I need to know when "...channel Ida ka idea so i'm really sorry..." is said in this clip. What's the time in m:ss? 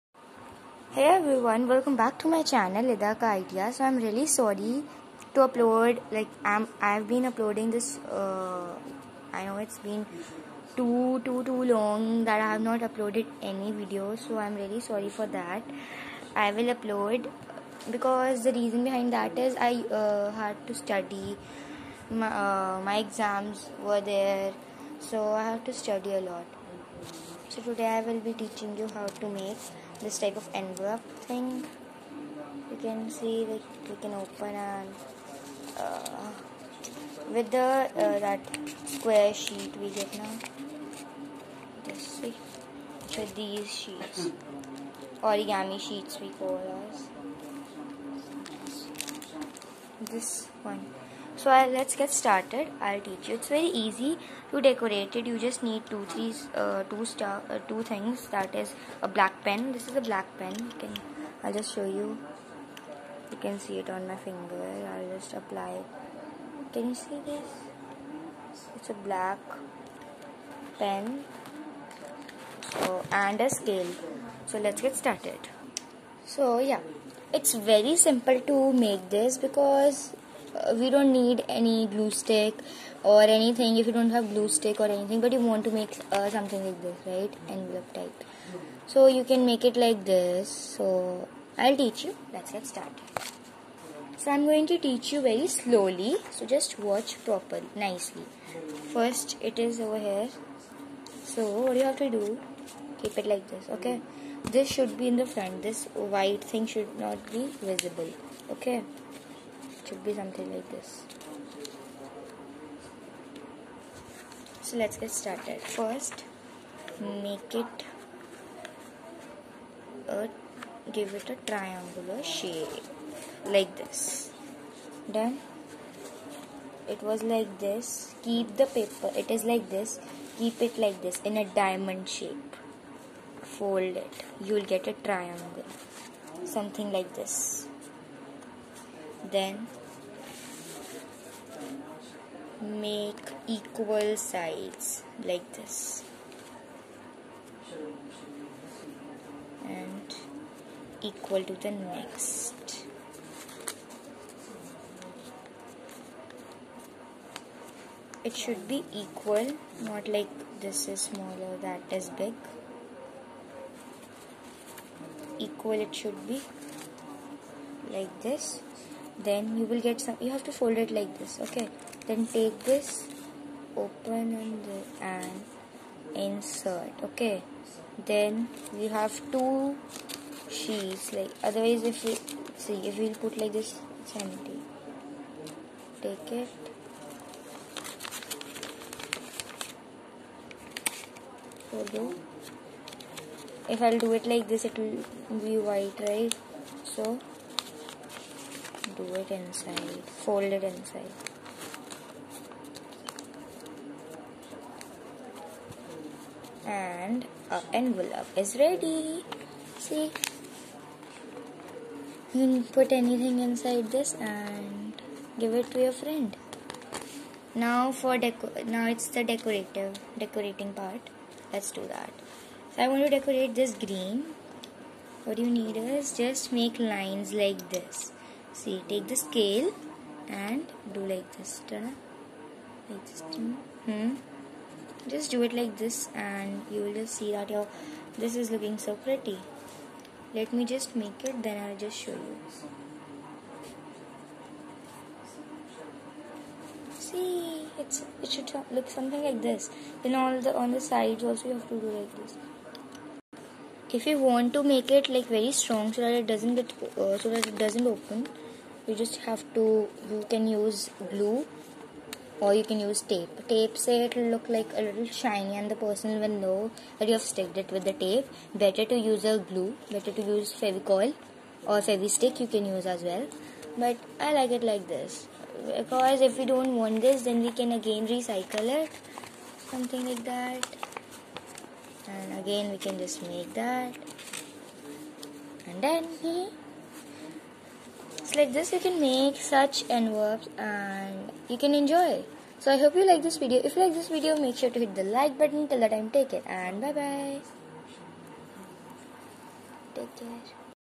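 0:02.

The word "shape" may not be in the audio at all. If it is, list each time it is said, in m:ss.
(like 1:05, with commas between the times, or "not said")
2:02, 2:12.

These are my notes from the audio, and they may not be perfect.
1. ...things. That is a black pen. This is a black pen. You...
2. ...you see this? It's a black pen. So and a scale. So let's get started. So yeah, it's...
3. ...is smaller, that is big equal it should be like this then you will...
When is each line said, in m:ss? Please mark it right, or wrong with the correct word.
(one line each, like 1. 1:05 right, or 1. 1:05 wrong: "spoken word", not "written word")
1. 0:57 right
2. 1:06 right
3. 2:40 right.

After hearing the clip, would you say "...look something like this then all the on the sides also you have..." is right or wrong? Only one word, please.
right.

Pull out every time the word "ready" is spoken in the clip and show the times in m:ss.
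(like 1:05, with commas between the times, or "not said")
3:28.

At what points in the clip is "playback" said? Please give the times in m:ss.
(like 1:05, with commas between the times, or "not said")
not said.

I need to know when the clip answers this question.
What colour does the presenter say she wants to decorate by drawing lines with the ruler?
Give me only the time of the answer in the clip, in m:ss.
3:43.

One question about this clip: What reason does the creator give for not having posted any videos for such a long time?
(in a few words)
Exams.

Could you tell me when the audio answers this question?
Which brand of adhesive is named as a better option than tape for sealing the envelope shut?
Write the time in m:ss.
4:30.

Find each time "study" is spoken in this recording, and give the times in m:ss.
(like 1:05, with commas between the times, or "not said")
0:20, 0:25.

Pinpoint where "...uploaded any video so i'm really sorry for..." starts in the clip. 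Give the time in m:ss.
0:12.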